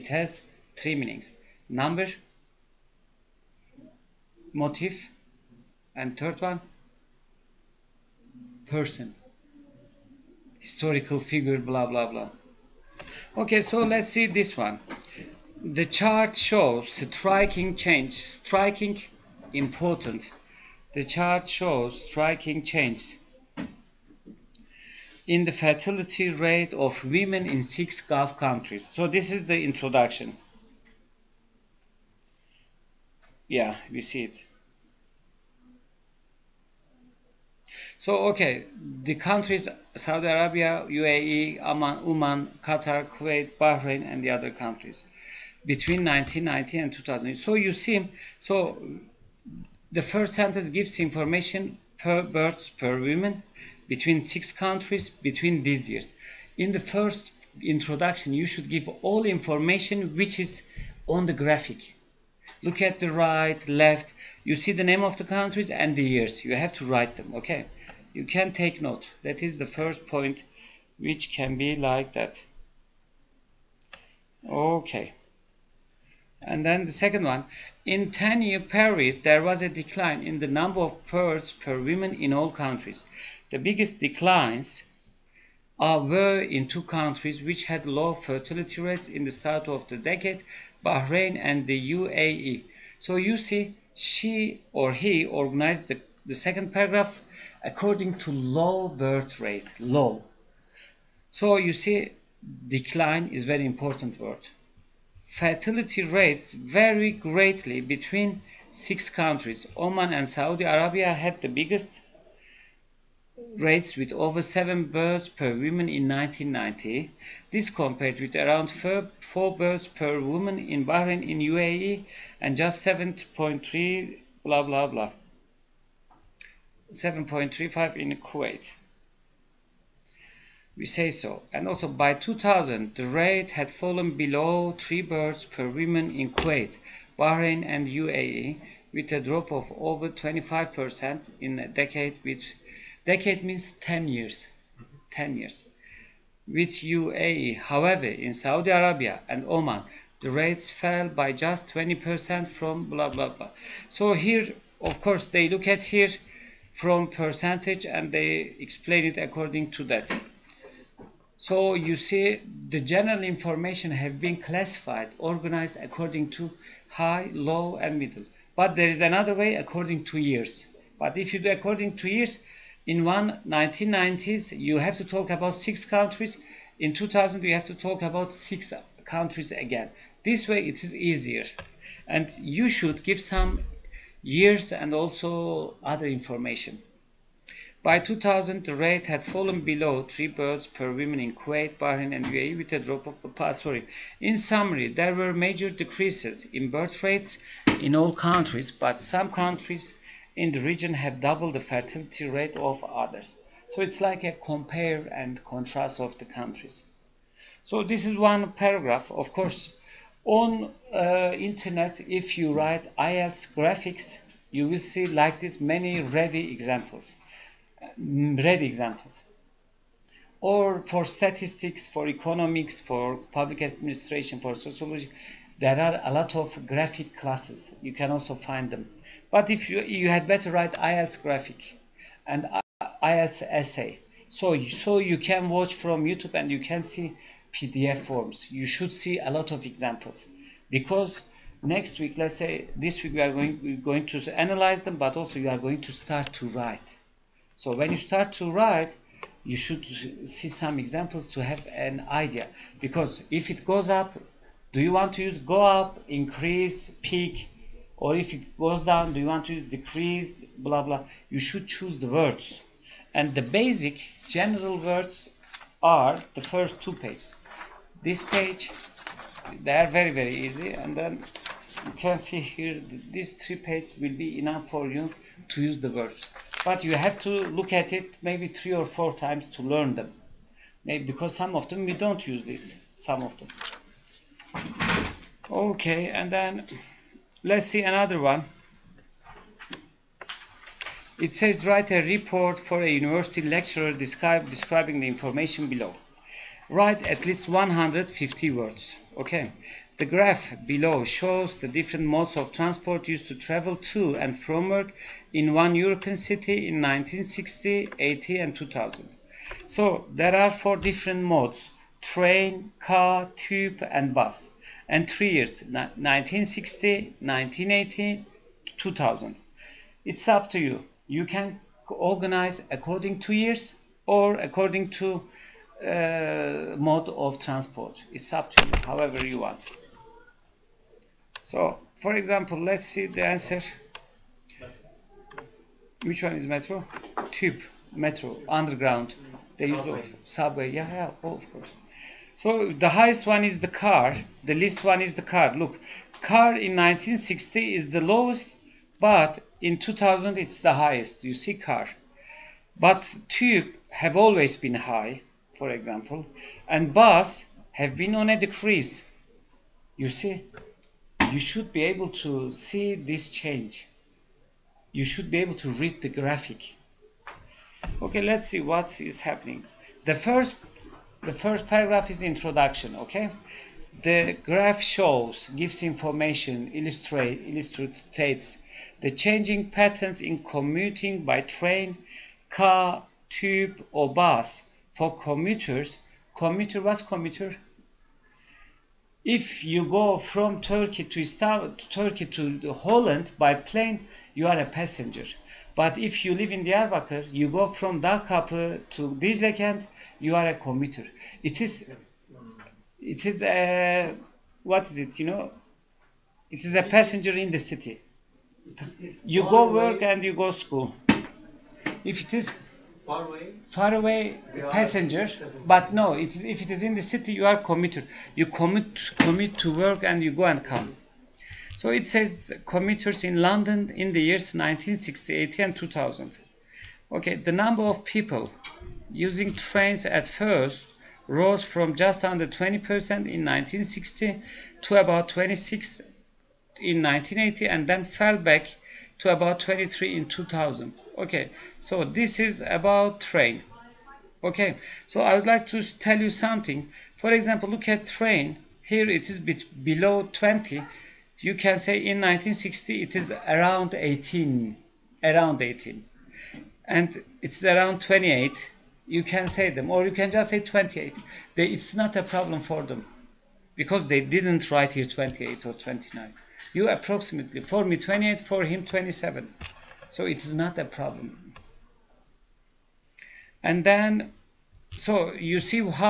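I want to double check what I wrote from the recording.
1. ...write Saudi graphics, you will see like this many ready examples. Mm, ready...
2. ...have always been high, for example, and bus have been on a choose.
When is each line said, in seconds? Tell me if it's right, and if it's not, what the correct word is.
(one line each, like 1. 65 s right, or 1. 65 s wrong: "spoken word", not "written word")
1. 212 s wrong: "IELTS", not "Saudi"
2. 353 s wrong: "decrease", not "choose".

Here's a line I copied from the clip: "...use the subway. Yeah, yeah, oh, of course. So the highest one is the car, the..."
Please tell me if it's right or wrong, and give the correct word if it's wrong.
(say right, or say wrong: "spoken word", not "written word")
right.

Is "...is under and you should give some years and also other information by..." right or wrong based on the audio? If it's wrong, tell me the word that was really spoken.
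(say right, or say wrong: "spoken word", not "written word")
wrong: "easier", not "under".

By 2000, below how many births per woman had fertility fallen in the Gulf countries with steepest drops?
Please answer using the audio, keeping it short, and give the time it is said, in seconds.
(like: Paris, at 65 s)
3, at 134 s.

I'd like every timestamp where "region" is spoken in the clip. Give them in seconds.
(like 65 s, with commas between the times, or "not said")
200 s.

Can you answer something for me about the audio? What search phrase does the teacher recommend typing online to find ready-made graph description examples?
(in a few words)
IELTS graphic.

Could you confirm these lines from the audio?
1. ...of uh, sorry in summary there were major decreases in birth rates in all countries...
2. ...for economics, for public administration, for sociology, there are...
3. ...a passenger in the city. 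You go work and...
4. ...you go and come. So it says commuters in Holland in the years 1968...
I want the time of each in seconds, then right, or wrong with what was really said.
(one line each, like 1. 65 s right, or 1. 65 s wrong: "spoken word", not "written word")
1. 193 s right
2. 221 s right
3. 406 s right
4. 420 s wrong: "London", not "Holland".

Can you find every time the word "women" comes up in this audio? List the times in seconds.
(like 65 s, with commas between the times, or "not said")
27 s, 53 s.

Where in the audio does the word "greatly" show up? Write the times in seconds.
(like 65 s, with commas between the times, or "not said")
107 s.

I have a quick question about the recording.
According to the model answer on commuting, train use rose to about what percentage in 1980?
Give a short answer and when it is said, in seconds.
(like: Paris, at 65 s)
26%, at 434 s.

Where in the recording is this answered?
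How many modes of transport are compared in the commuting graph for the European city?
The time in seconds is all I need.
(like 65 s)
310 s.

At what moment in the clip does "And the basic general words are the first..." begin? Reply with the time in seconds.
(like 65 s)
263 s.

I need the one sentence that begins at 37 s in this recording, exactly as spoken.
So, okay, the countries Saudi Arabia, UAE, Oman, Oman, Qatar, Kuwait, Bahrain, and the other countries between 1990 and 2000.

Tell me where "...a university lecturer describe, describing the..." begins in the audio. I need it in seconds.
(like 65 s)
292 s.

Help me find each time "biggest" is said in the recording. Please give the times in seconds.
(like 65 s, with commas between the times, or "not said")
83 s, 111 s.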